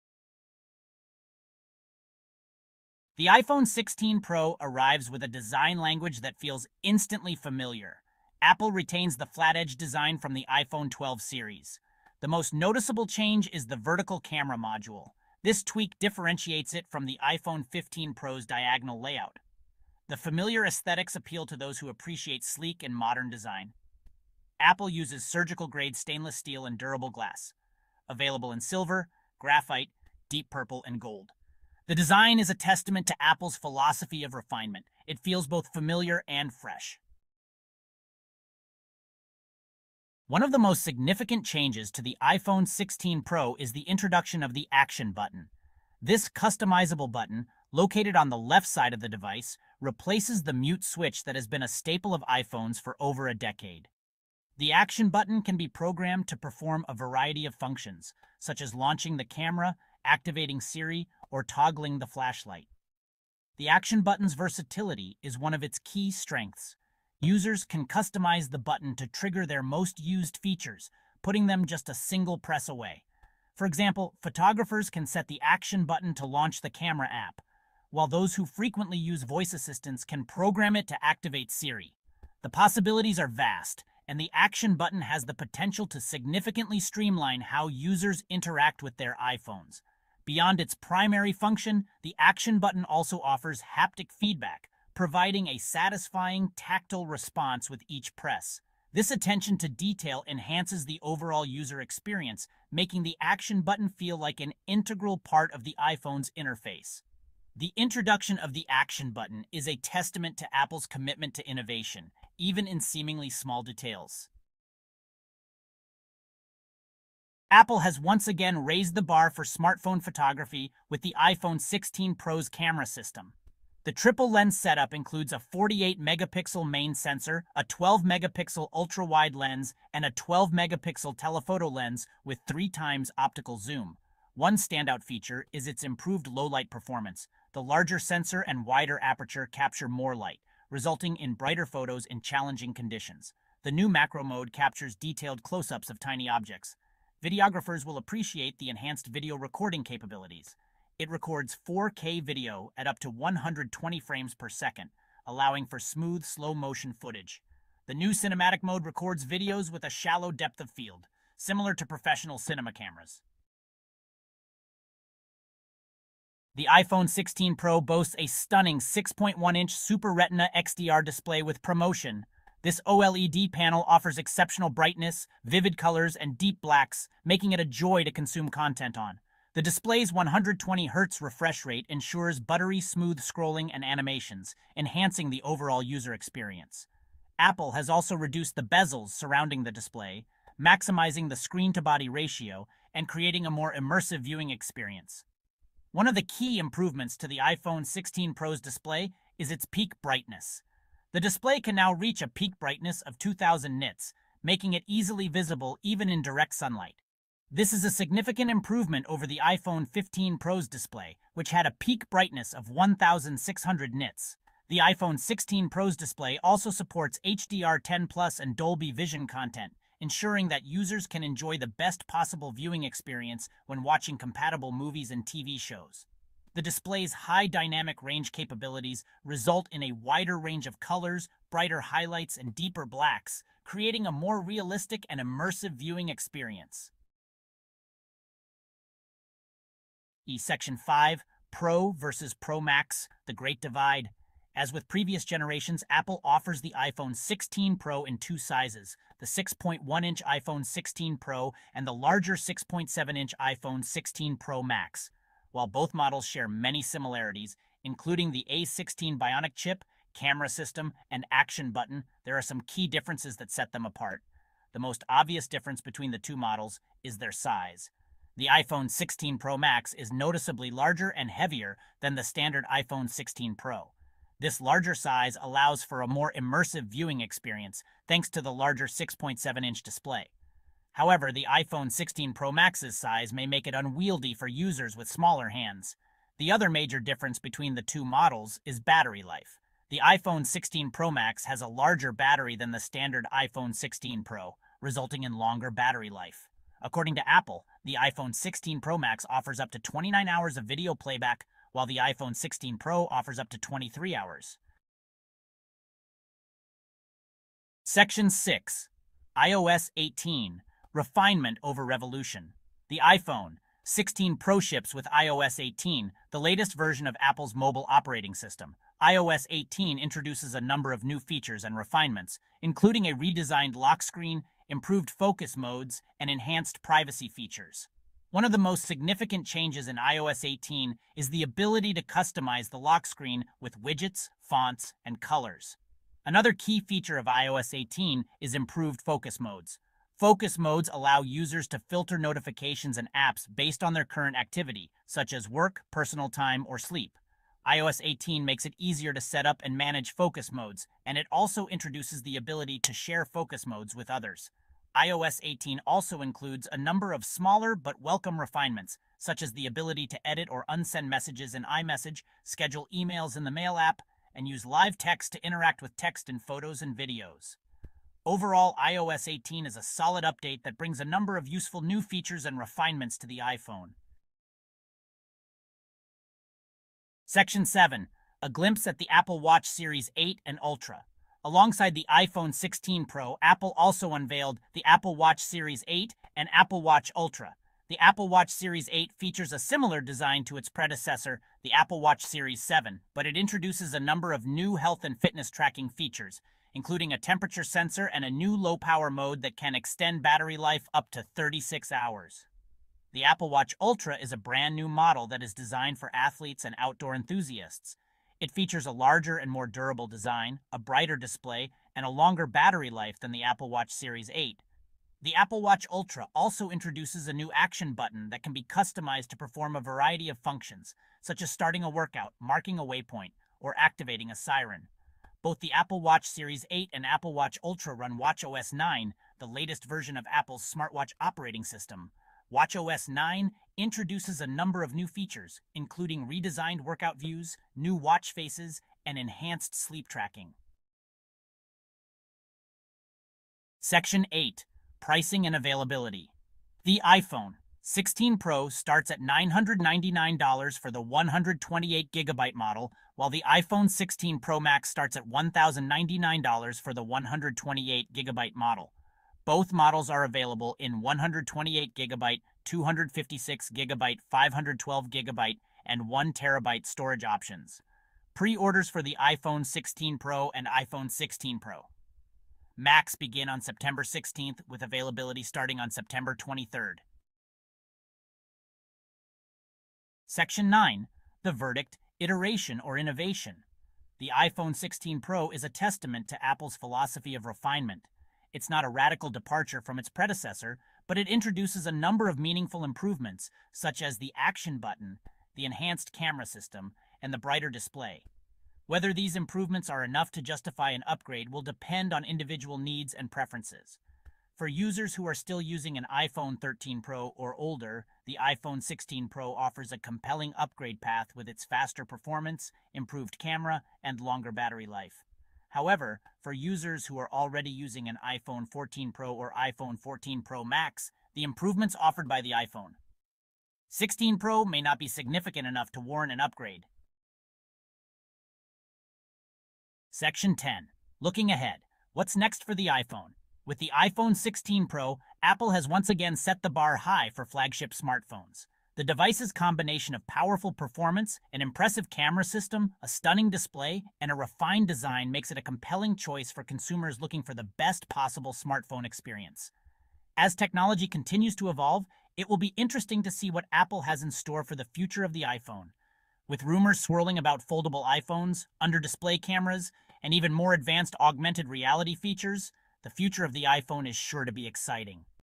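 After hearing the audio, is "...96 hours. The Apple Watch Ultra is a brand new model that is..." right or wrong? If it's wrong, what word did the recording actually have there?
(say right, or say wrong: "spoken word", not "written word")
wrong: "36", not "96".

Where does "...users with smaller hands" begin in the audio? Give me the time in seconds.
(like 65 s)
284 s.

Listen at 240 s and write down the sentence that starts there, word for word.
E-Section 5, Pro versus Pro Max, The Great Divide.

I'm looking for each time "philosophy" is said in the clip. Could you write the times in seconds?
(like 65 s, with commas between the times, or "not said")
33 s, 486 s.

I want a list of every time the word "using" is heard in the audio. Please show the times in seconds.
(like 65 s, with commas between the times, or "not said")
505 s, 517 s.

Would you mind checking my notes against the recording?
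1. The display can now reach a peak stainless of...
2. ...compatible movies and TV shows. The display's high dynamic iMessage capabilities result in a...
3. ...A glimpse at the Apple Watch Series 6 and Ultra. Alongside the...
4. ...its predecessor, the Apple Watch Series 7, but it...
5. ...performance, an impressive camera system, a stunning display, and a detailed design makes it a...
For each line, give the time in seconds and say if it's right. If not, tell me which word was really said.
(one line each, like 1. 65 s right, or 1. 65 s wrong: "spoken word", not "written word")
1. 201 s wrong: "brightness", not "stainless"
2. 224 s wrong: "range", not "iMessage"
3. 378 s wrong: "8", not "6"
4. 390 s right
5. 540 s wrong: "refined", not "detailed".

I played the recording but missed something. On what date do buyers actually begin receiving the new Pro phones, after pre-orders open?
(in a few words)
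September 23.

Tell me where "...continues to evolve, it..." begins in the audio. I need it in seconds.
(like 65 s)
551 s.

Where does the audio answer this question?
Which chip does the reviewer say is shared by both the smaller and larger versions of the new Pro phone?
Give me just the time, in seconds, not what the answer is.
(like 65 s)
258 s.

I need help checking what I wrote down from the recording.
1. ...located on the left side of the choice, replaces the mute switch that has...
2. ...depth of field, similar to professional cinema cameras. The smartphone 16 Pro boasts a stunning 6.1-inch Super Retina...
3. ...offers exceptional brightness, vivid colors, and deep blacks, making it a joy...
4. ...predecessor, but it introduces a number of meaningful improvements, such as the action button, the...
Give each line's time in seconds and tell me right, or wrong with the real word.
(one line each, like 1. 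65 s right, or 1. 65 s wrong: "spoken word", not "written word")
1. 47 s wrong: "device", not "choice"
2. 160 s wrong: "iPhone", not "smartphone"
3. 173 s right
4. 490 s right.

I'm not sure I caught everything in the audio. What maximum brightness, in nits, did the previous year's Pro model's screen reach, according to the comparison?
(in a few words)
1600.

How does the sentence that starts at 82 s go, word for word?
The possibilities are vast, and the action button has the potential to significantly streamline how users interact with their iPhones.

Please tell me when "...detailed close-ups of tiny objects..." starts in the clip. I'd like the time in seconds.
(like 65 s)
144 s.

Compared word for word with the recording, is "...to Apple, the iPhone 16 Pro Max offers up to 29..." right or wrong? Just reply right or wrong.
right.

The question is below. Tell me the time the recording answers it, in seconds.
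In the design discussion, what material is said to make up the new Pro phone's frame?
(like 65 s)
25 s.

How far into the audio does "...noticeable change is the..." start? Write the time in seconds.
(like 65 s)
12 s.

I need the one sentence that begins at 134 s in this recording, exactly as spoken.
One standout feature is its improved low-light performance.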